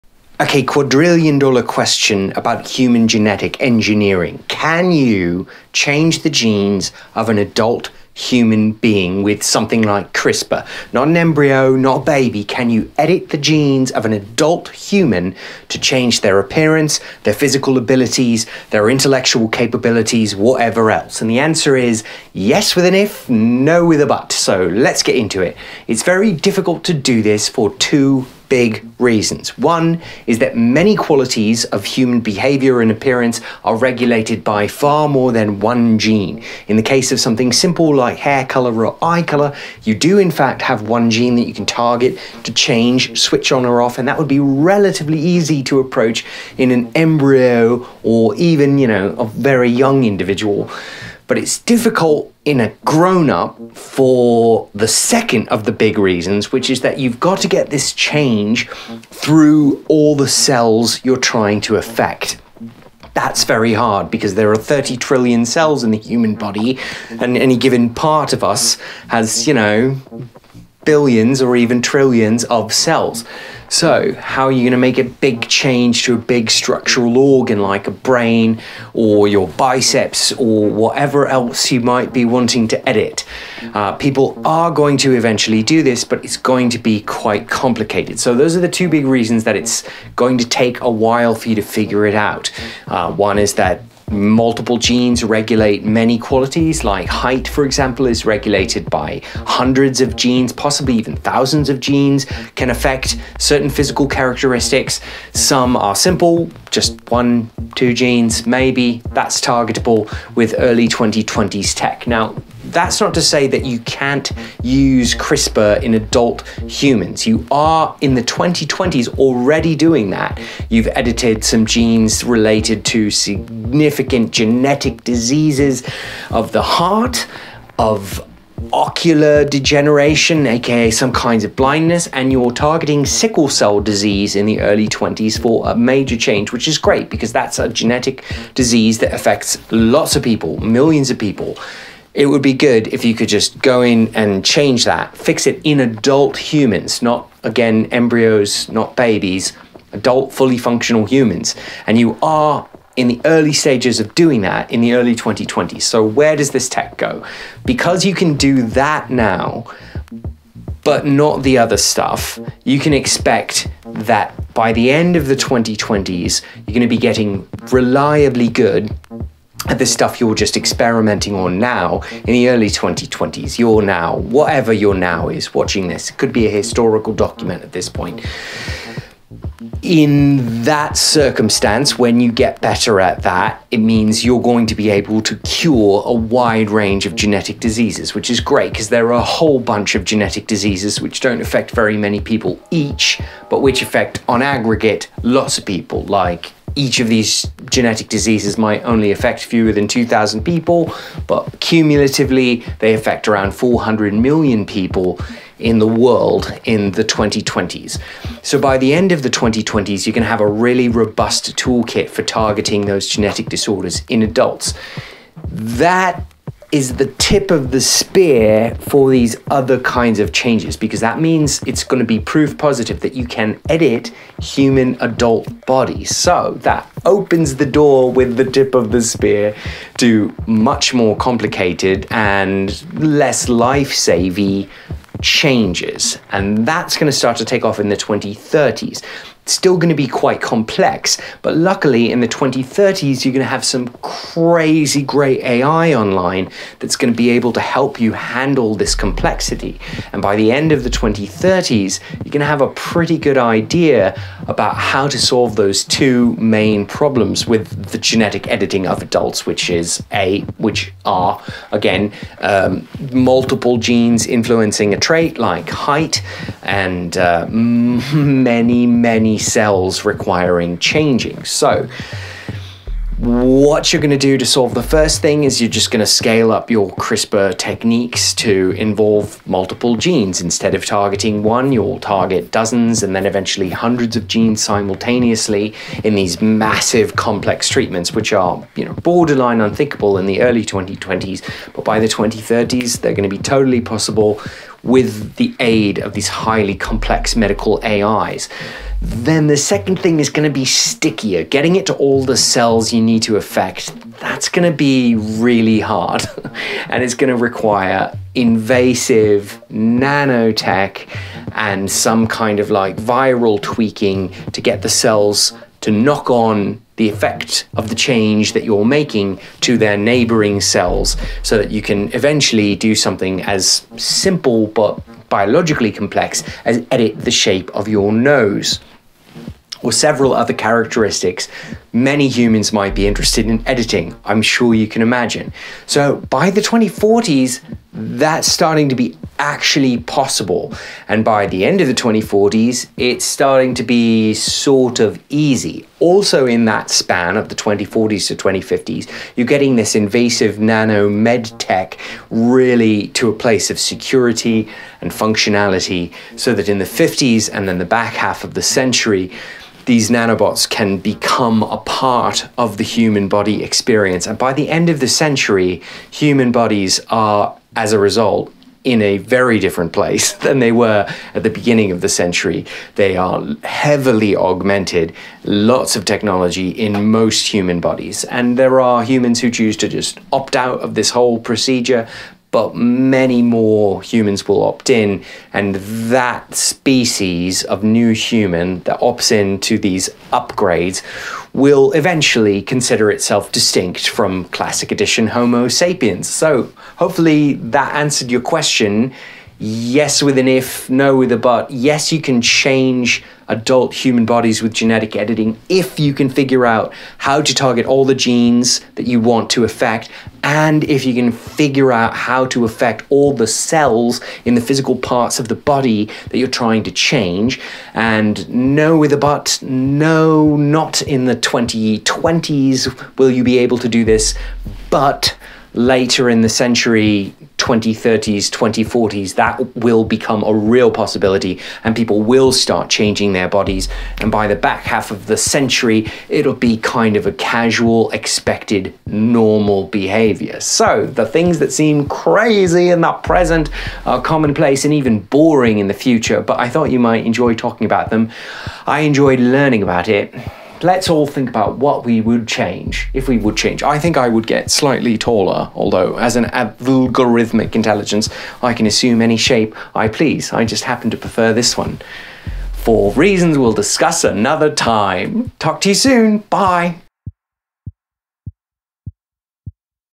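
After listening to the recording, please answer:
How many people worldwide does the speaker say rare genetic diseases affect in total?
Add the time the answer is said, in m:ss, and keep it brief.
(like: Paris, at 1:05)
400 million, at 3:23.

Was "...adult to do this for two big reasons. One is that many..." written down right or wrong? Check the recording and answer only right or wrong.
wrong.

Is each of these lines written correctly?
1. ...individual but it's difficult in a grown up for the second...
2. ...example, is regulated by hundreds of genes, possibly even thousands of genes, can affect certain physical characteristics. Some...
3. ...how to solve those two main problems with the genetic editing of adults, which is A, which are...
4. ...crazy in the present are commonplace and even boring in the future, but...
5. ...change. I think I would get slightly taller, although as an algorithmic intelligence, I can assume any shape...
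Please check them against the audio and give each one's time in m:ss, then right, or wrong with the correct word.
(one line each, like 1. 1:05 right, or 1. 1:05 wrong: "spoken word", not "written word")
1. 0:50 right
2. 1:37 right
3. 4:14 right
4. 7:22 right
5. 7:33 right.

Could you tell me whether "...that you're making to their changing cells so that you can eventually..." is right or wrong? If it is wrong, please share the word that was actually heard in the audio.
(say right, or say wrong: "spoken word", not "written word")
wrong: "neighboring", not "changing".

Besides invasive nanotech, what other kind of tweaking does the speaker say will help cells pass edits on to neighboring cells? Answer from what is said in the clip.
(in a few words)
Viral tweaking.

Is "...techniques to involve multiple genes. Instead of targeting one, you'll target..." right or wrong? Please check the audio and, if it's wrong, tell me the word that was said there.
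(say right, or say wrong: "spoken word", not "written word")
right.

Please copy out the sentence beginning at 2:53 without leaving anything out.
You're now, whatever your now is, watching this.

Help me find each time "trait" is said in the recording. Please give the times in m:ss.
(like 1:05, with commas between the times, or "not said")
4:24.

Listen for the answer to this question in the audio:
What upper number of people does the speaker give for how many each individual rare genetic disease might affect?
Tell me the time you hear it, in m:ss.
3:19.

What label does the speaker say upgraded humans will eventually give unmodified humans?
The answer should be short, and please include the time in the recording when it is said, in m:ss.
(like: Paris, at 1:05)
Classic edition Homo sapiens, at 6:34.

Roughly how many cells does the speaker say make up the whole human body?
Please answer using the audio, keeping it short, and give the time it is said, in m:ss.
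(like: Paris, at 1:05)
30 trillion, at 1:04.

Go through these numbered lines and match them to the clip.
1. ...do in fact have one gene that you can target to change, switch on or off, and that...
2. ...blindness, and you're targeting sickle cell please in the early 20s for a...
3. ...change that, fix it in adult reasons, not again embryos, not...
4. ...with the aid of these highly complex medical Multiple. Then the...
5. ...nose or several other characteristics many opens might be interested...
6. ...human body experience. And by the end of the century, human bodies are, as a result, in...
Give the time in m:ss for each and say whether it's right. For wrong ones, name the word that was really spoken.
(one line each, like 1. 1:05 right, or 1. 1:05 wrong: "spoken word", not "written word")
1. 0:39 right
2. 2:11 wrong: "disease", not "please"
3. 2:24 wrong: "humans", not "reasons"
4. 4:54 wrong: "AIs", not "Multiple"
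5. 5:28 wrong: "humans", not "opens"
6. 6:02 right.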